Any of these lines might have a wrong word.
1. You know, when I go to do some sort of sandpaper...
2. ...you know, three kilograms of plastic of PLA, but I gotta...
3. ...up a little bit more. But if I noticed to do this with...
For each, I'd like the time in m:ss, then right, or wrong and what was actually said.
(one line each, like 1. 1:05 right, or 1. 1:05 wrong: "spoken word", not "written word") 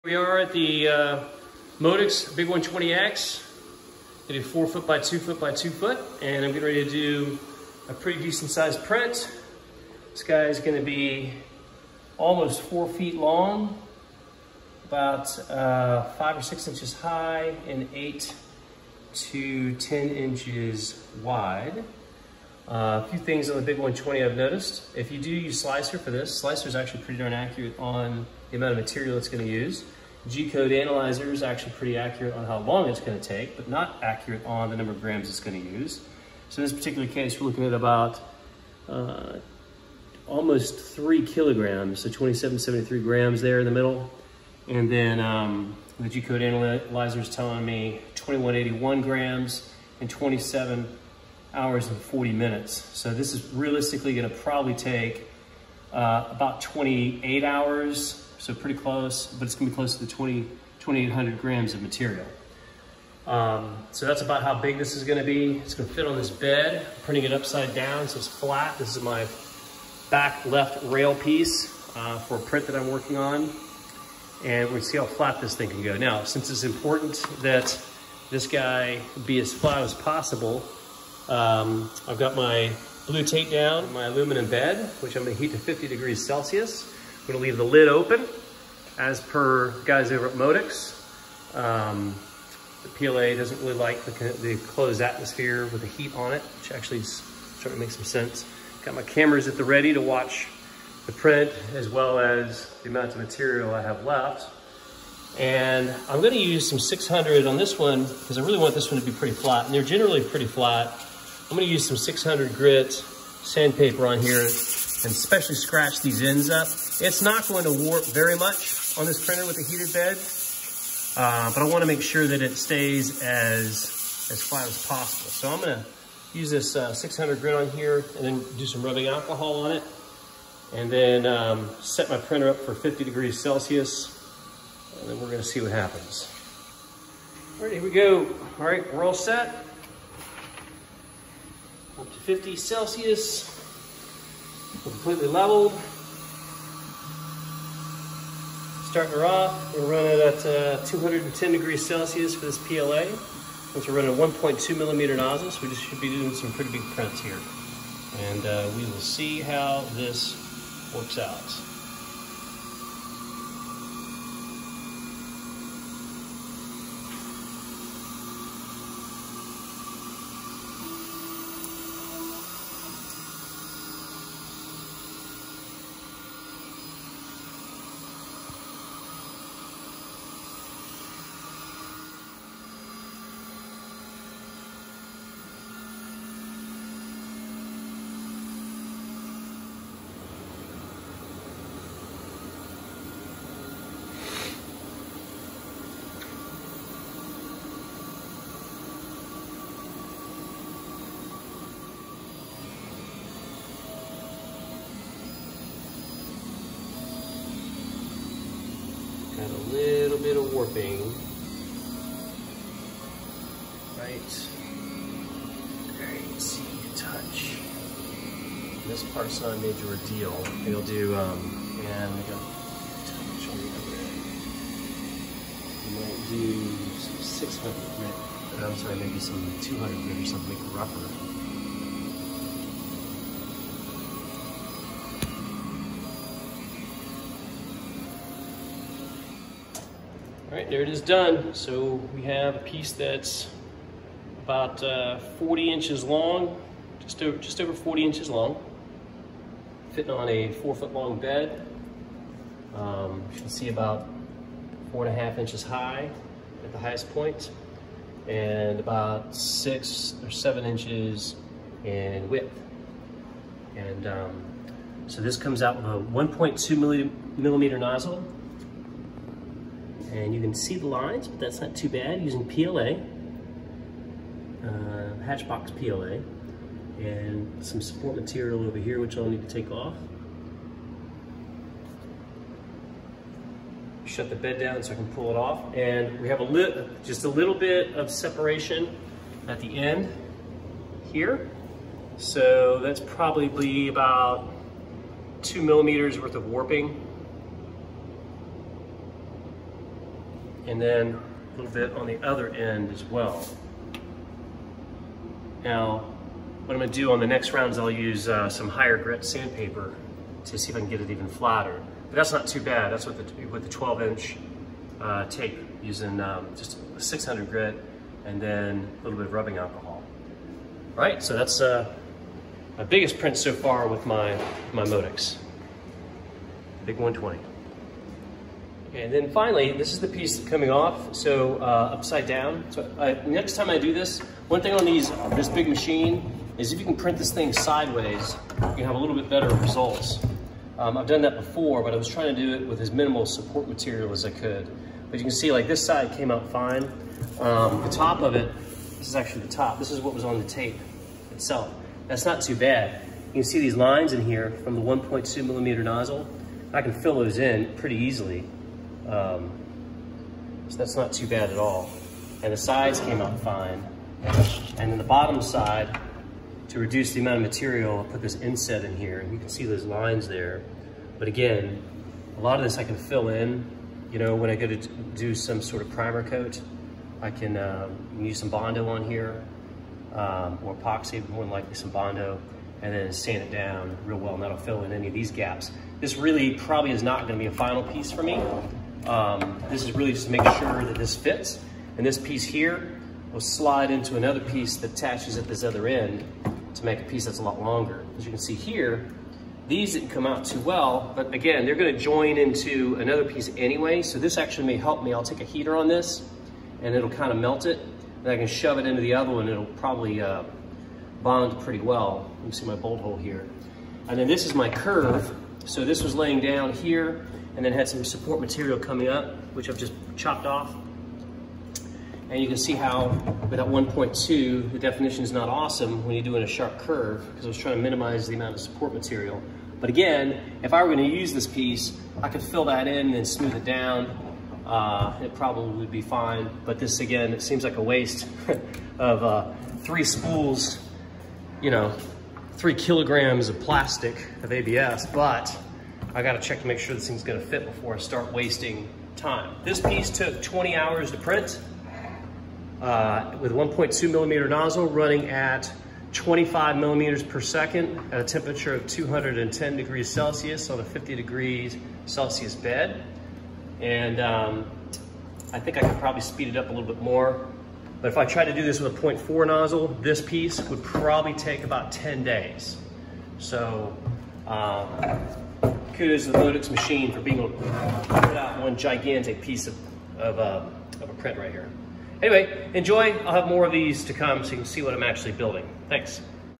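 1. 6:14 wrong: "primer", not "sandpaper"
2. 7:21 wrong: "ABS", not "PLA"
3. 7:46 wrong: "tried", not "noticed".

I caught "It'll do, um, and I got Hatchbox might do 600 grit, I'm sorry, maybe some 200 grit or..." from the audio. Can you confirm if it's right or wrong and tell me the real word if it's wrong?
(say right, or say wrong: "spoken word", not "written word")
wrong: "You", not "Hatchbox".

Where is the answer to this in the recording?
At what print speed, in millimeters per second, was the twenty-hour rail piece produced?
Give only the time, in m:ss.
7:36.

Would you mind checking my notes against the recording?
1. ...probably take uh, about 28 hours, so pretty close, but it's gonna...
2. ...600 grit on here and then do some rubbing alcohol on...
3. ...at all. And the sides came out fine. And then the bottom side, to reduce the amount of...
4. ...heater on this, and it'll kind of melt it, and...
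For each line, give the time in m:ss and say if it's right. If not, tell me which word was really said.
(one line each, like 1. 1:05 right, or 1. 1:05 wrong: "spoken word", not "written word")
1. 0:54 right
2. 2:06 right
3. 6:01 right
4. 6:45 right.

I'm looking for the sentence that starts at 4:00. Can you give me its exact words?
All right, there it is done.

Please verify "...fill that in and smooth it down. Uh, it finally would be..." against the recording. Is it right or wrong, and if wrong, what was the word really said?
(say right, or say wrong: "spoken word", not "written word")
wrong: "probably", not "finally".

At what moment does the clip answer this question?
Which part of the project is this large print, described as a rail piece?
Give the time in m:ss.
1:10.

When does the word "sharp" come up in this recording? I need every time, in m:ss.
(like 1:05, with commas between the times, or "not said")
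7:06.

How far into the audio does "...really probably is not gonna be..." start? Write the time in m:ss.
6:26.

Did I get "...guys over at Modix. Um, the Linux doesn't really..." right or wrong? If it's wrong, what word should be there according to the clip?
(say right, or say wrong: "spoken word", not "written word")
wrong: "PLA", not "Linux".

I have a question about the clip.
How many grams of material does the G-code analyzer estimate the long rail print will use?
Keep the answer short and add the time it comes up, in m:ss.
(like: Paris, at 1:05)
2181 grams, at 0:48.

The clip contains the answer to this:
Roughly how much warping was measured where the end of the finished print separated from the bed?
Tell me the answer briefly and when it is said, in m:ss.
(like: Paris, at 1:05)
2 millimeters, at 4:53.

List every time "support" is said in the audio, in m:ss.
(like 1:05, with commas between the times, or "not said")
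4:37, 5:43, 6:58, 7:08.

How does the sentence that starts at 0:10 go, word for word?
This guy is gonna be almost four feet long, about uh, five or six inches high, and eight to 10 inches wide.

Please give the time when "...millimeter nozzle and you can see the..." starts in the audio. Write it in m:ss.
4:27.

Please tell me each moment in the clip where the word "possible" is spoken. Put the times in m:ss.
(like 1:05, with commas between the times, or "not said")
1:19, 2:04.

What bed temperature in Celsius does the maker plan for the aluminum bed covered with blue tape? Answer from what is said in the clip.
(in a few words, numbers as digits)
50 degrees Celsius.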